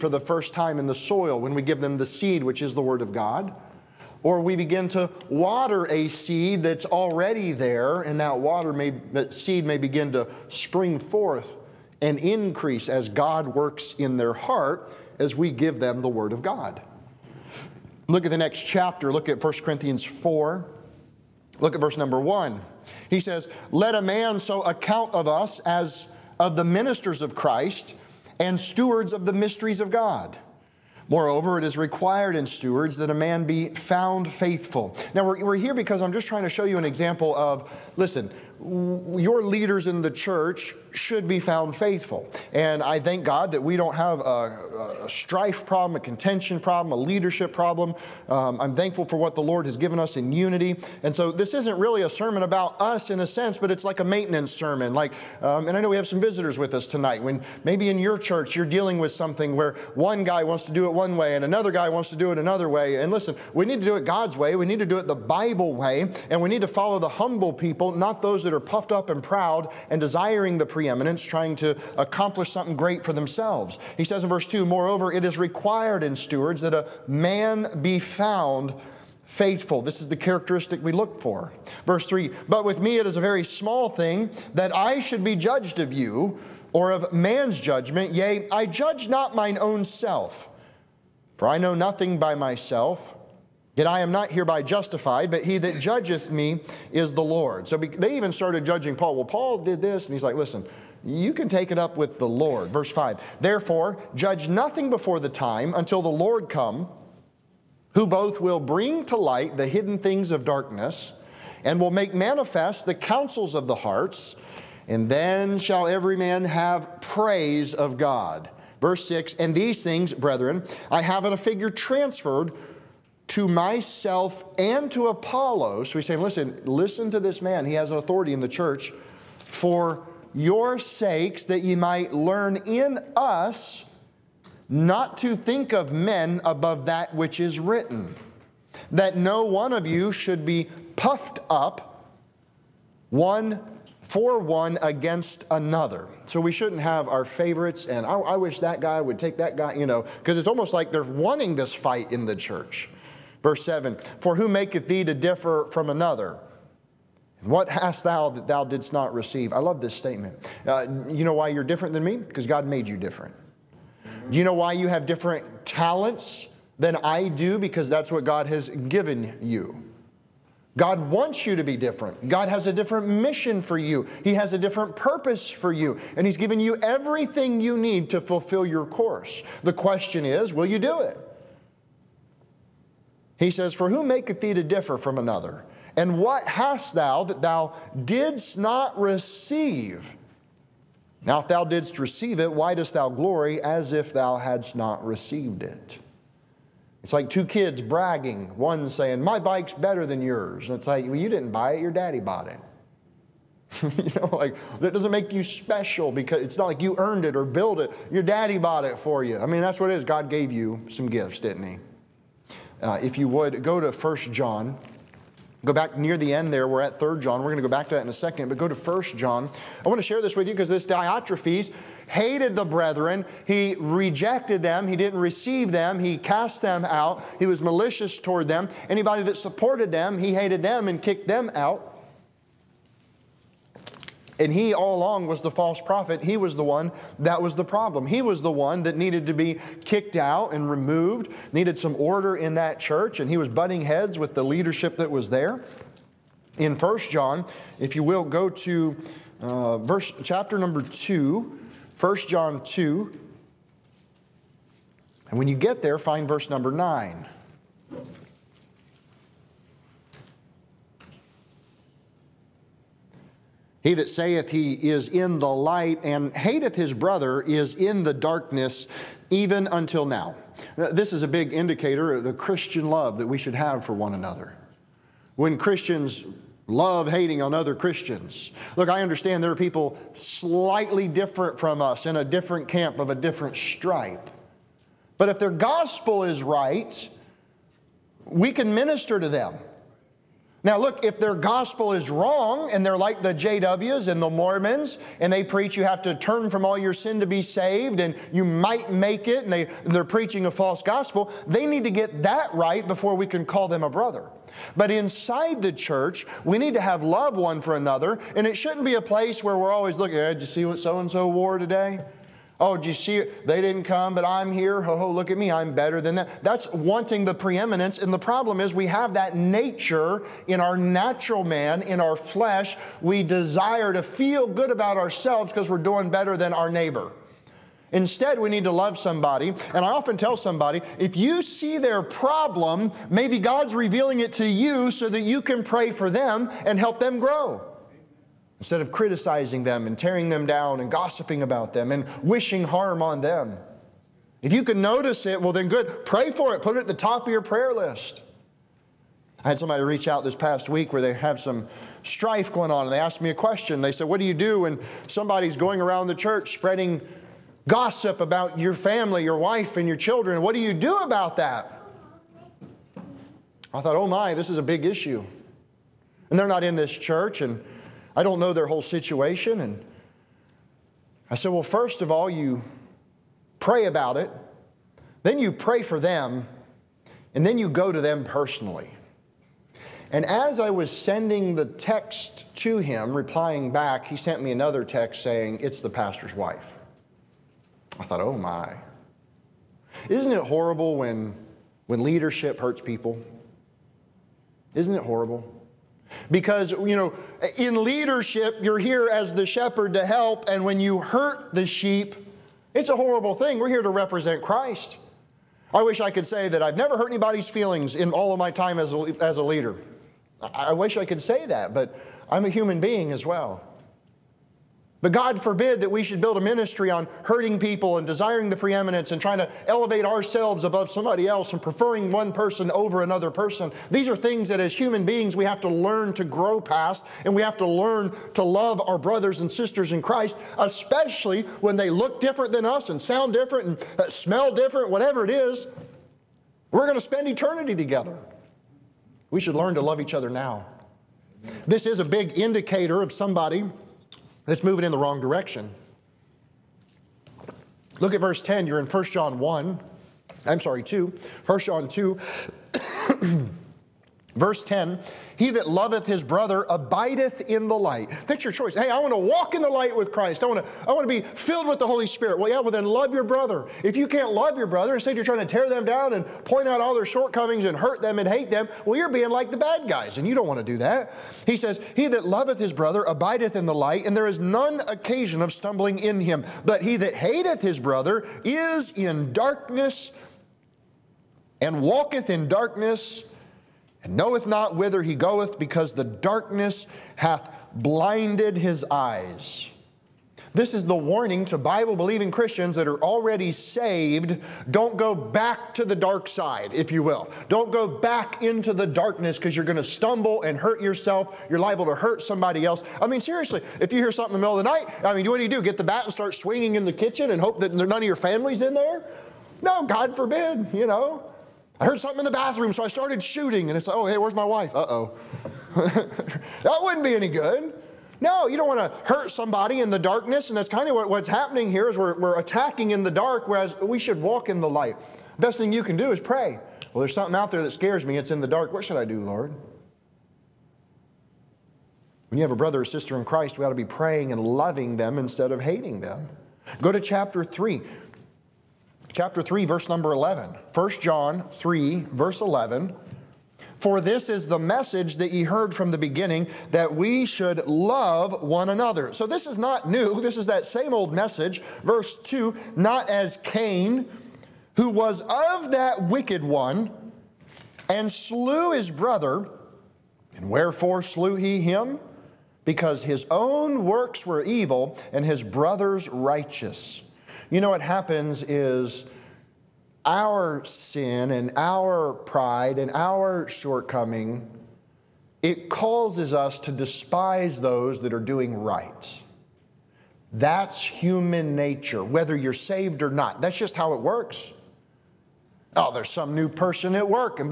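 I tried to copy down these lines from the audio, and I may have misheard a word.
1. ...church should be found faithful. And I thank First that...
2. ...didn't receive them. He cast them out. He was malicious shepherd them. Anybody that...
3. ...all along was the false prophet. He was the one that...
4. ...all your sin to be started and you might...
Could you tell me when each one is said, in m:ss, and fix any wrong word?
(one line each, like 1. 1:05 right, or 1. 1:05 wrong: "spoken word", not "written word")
1. 0:40 wrong: "God", not "First"
2. 3:44 wrong: "toward", not "shepherd"
3. 3:54 right
4. 4:56 wrong: "saved", not "started".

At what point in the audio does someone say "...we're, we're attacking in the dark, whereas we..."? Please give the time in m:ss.
8:41.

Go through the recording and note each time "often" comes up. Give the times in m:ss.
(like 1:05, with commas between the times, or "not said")
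5:29.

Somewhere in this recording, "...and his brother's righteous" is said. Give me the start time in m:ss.
9:25.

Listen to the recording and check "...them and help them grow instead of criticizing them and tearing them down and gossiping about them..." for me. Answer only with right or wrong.
right.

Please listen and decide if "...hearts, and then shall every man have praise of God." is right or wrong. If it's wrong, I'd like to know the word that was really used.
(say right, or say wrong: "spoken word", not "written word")
right.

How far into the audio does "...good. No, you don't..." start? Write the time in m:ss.
8:37.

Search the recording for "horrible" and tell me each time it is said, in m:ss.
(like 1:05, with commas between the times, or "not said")
6:30, 6:35, 6:42.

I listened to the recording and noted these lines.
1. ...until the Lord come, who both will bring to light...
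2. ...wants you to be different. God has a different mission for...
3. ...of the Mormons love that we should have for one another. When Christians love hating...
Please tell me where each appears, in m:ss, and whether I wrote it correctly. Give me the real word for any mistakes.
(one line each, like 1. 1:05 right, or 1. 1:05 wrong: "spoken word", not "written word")
1. 1:45 right
2. 2:51 right
3. 4:32 wrong: "Christian", not "Mormons".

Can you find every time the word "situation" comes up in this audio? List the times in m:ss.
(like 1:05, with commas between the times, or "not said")
6:08.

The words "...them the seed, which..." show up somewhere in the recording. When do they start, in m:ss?
0:01.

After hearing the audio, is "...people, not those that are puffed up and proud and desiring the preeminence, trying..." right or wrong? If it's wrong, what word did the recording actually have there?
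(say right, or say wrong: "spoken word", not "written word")
right.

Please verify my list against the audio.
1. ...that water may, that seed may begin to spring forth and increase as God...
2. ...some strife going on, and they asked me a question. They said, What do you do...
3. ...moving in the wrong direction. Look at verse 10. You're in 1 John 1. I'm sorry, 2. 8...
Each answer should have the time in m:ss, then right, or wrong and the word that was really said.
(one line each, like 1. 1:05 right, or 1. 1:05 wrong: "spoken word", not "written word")
1. 0:08 right
2. 5:51 right
3. 7:24 wrong: "1", not "8".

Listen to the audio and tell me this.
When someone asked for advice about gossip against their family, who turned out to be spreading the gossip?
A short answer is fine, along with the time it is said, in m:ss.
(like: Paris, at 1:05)
The pastor's wife, at 6:25.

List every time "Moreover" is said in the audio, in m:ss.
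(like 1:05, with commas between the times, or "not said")
0:31, 1:14.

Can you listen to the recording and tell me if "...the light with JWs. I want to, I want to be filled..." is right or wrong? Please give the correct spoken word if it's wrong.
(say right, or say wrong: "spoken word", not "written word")
wrong: "Christ", not "JWs".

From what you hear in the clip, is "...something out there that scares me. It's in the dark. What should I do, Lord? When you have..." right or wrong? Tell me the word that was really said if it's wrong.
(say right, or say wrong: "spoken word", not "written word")
right.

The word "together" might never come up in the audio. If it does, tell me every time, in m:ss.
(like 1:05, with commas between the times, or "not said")
7:17.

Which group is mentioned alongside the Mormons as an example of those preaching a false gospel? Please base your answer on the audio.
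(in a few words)
The JWs.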